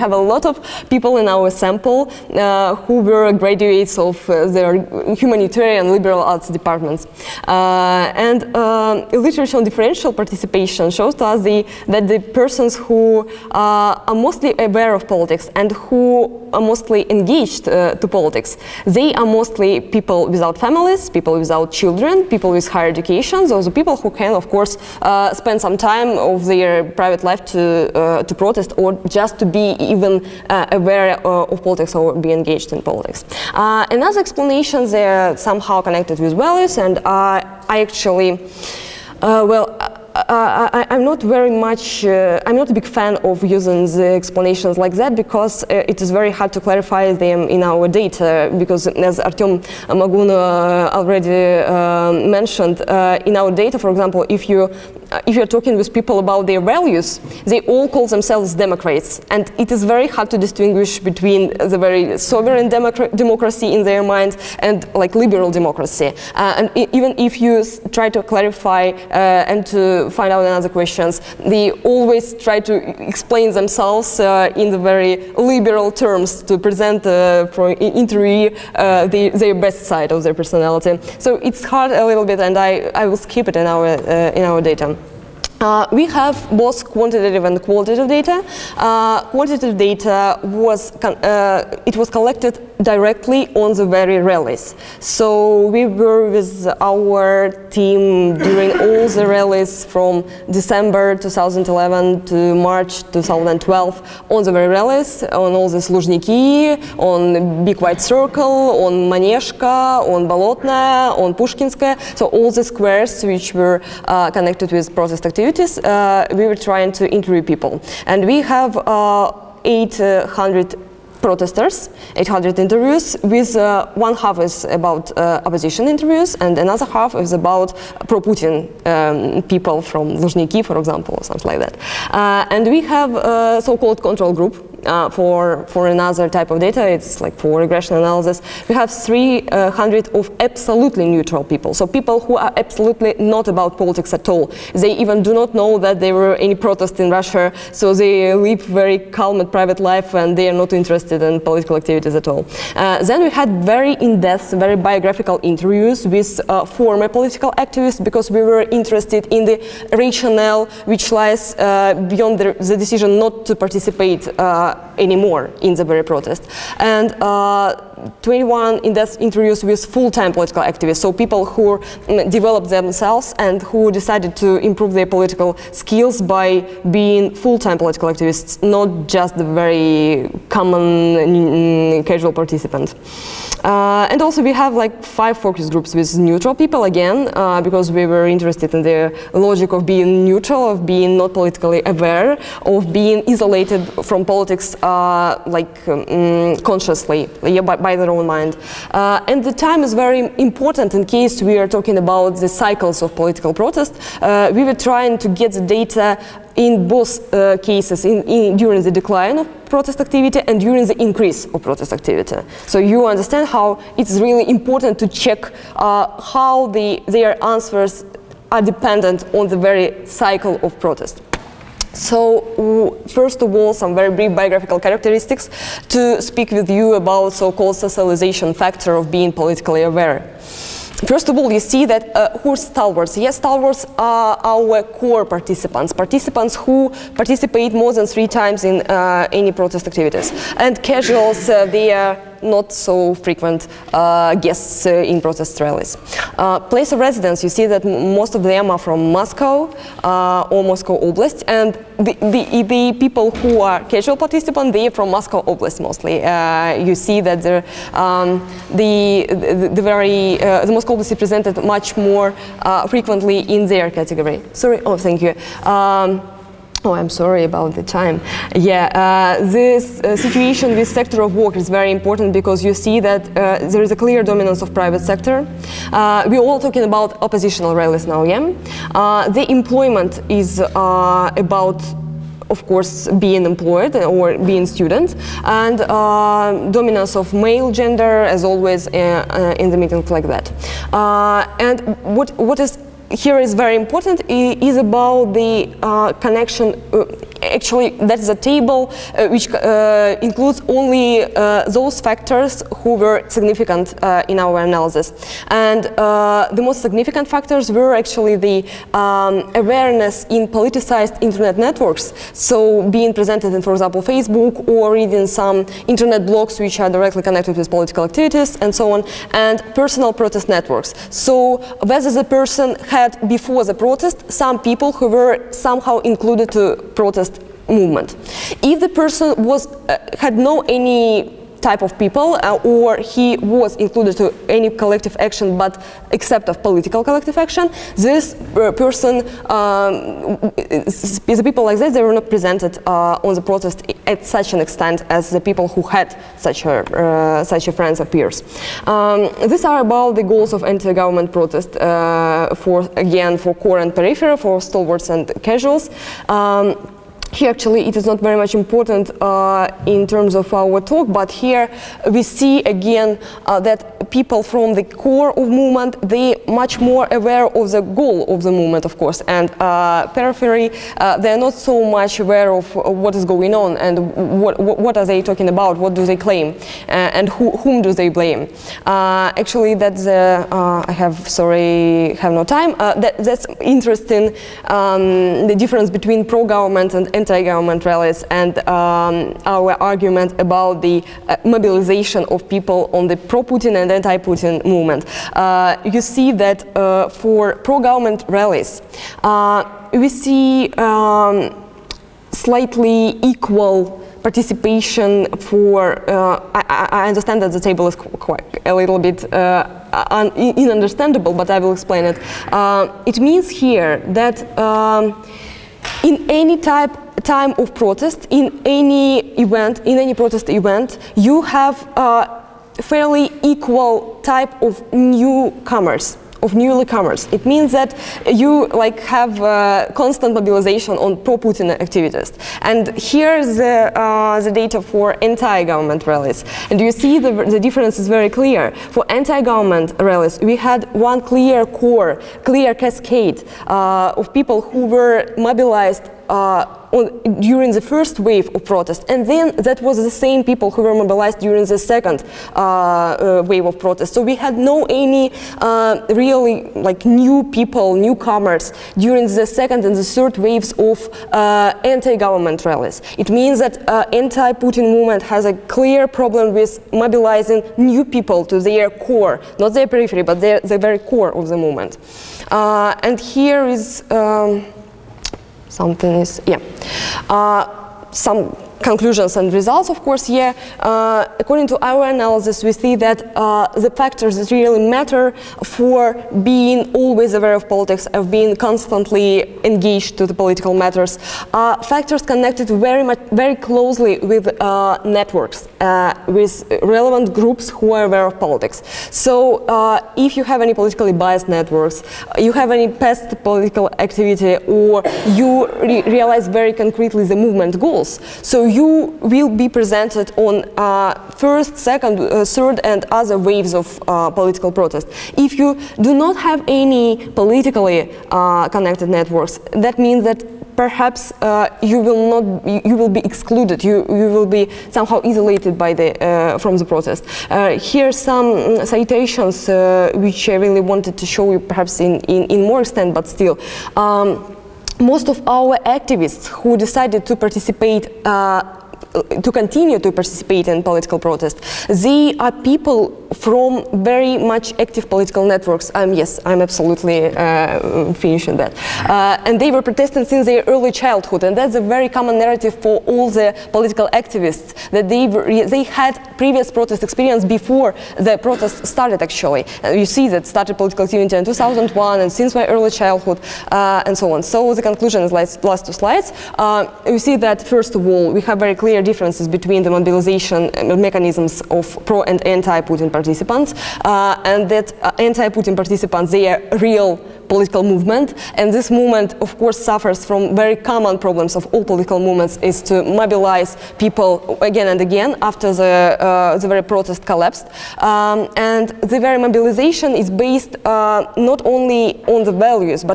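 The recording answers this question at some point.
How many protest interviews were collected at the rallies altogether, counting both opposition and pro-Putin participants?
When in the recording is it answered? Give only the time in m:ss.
2:02.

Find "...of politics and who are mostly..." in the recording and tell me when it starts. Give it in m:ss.
0:14.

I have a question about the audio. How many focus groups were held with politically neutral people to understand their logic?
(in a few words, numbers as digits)
5.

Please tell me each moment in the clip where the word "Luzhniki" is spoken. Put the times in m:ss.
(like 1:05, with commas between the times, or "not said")
1:45, 2:10.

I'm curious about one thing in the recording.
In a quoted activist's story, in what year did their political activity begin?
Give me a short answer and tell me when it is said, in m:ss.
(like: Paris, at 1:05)
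2001, at 9:21.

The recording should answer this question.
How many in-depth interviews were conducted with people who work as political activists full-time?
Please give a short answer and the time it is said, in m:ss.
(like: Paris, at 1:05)
21, at 2:48.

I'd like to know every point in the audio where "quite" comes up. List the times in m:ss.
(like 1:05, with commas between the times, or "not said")
6:47.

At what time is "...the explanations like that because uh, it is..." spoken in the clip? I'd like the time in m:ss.
0:43.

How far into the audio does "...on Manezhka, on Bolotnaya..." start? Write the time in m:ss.
1:48.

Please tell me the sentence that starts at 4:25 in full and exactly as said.
Um, Oh, I'm sorry about the time.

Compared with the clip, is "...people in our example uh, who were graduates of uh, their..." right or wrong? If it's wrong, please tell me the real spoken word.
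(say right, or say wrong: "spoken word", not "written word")
wrong: "sample", not "example".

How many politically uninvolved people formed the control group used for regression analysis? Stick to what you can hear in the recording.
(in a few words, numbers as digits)
300.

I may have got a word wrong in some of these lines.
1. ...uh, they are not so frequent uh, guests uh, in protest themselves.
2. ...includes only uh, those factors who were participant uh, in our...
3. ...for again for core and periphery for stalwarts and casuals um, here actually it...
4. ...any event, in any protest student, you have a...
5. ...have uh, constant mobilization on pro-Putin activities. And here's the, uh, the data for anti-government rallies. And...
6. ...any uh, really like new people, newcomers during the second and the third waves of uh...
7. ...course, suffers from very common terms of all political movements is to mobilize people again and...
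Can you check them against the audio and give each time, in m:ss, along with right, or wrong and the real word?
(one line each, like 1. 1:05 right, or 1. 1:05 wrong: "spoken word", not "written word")
1. 4:01 wrong: "rallies", not "themselves"
2. 5:00 wrong: "significant", not "participant"
3. 5:52 right
4. 6:58 wrong: "event", not "student"
5. 7:09 right
6. 7:34 right
7. 9:39 wrong: "problems", not "terms".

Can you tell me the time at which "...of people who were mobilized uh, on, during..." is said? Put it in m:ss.
7:24.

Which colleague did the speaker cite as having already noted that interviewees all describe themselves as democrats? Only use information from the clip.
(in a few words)
Artem Magun.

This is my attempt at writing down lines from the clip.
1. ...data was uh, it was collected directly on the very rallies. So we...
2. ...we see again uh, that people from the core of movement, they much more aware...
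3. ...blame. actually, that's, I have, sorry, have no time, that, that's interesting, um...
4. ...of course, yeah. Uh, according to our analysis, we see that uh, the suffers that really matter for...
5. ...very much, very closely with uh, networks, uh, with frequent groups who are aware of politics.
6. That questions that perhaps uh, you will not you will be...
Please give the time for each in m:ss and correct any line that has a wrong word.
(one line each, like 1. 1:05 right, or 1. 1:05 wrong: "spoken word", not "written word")
1. 1:29 right
2. 6:02 right
3. 6:18 right
4. 7:59 wrong: "factors", not "suffers"
5. 8:12 wrong: "relevant", not "frequent"
6. 8:39 wrong: "means", not "questions".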